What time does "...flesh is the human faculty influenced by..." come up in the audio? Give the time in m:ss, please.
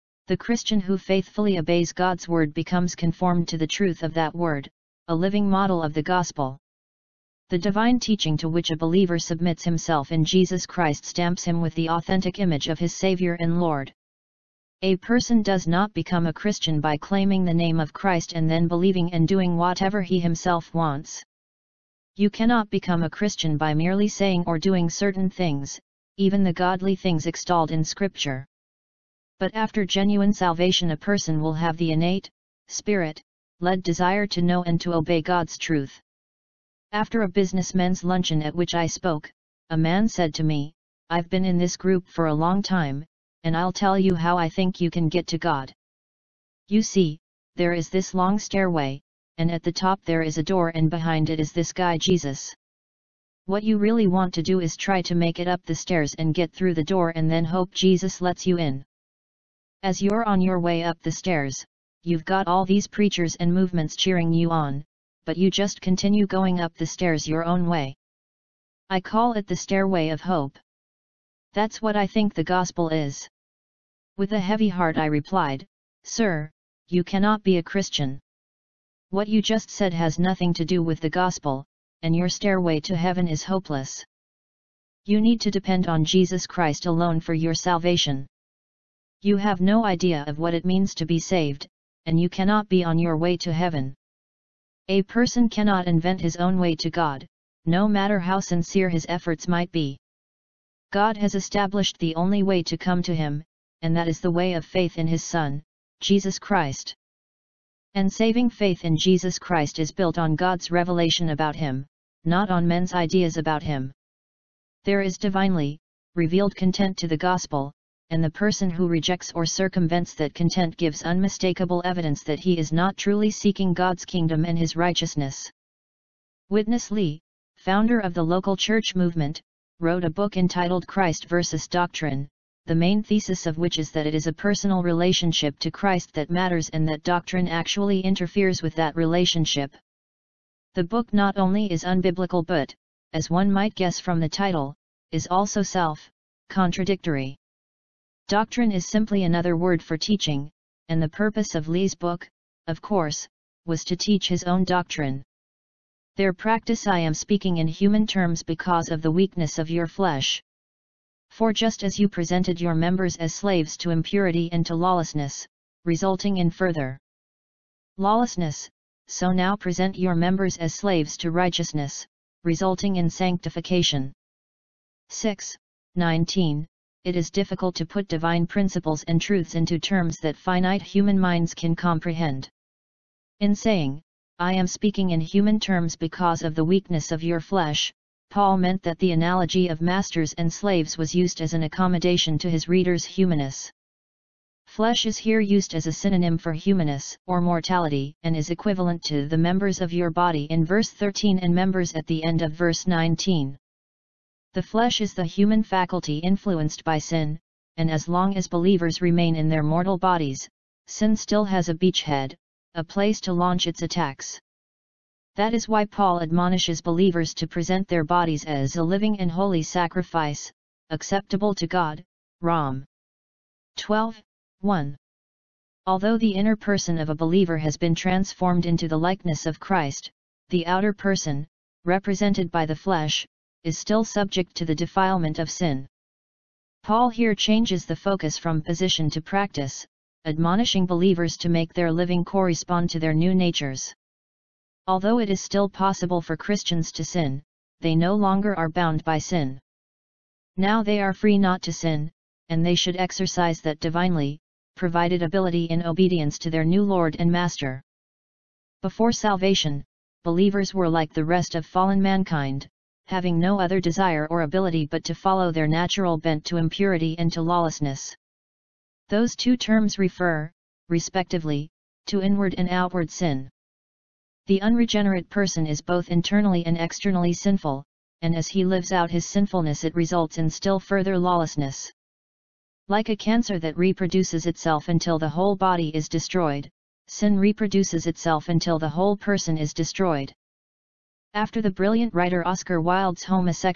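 3:24.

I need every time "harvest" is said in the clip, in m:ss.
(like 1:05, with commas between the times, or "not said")
not said.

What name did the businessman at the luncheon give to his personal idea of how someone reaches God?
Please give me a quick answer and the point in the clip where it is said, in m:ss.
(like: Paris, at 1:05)
the stairway of hope, at 1:09.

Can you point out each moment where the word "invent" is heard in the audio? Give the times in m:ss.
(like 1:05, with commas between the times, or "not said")
1:35.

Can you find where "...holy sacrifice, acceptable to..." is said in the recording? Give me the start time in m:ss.
3:39.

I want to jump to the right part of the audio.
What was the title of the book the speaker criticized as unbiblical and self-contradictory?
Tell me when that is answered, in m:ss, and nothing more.
2:10.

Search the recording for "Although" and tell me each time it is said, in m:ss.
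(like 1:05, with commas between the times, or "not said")
3:45, 4:04.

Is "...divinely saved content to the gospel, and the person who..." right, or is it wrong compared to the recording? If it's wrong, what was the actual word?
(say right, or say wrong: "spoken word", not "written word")
wrong: "revealed", not "saved".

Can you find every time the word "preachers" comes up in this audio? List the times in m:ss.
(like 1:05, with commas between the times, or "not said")
1:02.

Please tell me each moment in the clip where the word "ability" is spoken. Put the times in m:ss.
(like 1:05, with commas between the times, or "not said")
4:15, 4:24.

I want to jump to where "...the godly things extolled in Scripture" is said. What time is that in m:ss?
0:26.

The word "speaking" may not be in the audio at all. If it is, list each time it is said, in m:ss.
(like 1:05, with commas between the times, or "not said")
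2:37, 3:04.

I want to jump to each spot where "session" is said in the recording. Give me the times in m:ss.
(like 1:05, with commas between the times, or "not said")
not said.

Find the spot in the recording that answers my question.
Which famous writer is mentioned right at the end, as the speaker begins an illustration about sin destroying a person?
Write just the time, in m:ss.
4:52.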